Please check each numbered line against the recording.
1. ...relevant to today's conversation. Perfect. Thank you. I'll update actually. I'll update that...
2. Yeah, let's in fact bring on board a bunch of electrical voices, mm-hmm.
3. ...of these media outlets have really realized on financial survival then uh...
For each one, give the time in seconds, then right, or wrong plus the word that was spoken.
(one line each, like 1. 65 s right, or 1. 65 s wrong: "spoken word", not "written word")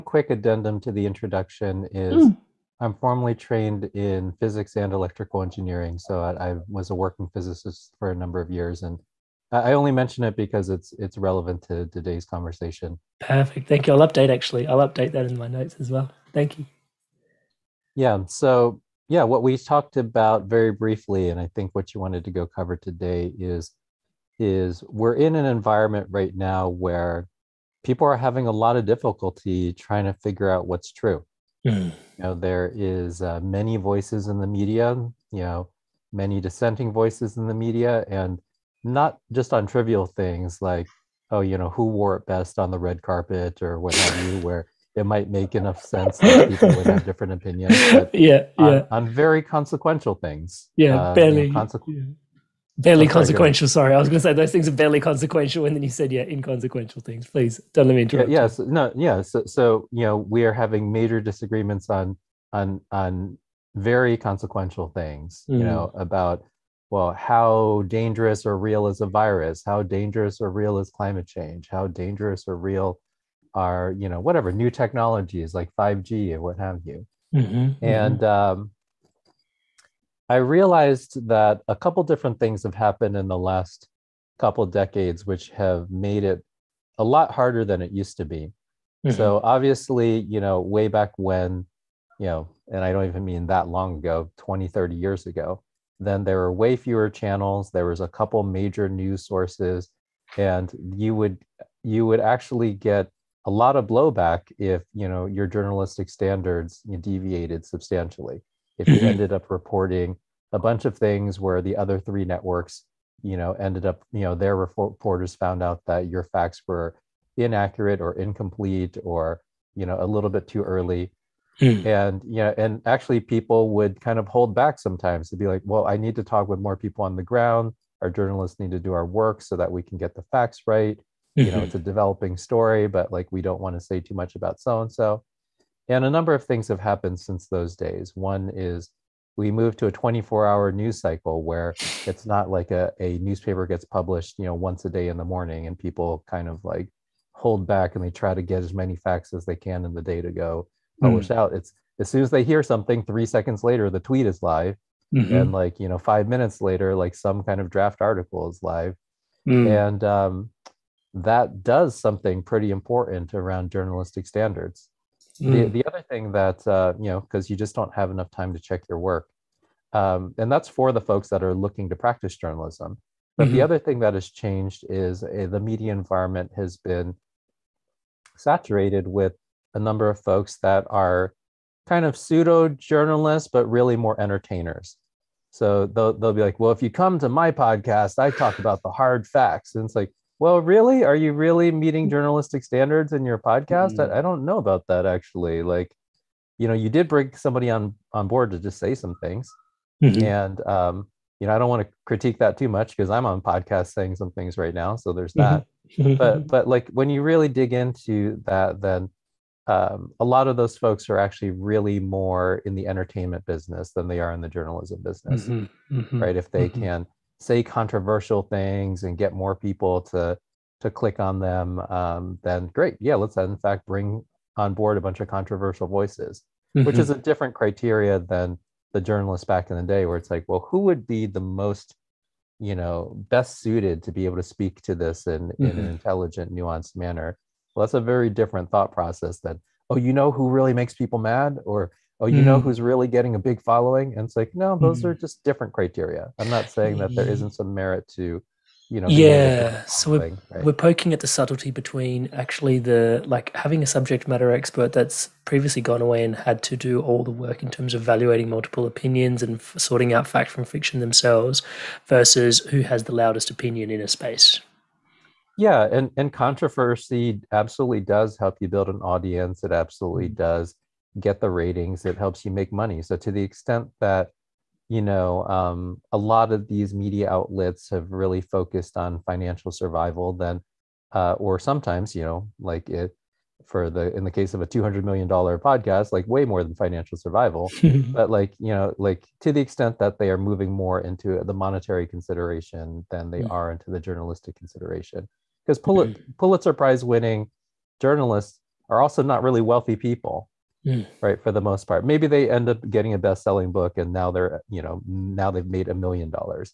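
1. 11 s right
2. 223 s wrong: "controversial", not "electrical"
3. 276 s wrong: "focused", not "realized".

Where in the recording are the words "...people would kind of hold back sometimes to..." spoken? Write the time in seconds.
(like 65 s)
123 s.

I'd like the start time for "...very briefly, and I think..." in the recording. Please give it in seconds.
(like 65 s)
20 s.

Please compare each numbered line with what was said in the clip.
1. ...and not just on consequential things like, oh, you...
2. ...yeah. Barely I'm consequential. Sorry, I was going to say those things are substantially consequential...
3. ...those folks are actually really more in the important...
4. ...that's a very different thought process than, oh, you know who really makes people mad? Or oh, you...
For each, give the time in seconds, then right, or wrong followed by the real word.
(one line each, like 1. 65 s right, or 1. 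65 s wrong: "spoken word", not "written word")
1. 38 s wrong: "trivial", not "consequential"
2. 51 s wrong: "barely", not "substantially"
3. 210 s wrong: "entertainment", not "important"
4. 237 s right.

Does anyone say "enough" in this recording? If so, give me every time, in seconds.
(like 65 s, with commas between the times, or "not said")
45 s, 168 s.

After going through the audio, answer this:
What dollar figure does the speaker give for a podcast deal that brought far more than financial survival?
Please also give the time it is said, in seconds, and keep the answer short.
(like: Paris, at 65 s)
200 million dollars, at 284 s.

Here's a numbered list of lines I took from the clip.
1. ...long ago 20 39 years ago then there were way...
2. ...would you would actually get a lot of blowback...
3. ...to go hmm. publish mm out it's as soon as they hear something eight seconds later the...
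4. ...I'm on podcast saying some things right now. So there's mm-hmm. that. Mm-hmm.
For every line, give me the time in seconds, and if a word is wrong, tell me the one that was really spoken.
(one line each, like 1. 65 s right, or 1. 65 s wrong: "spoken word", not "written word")
1. 93 s wrong: "30", not "39"
2. 101 s right
3. 150 s wrong: "three", not "eight"
4. 203 s right.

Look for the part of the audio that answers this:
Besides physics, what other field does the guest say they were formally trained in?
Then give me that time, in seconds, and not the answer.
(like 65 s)
4 s.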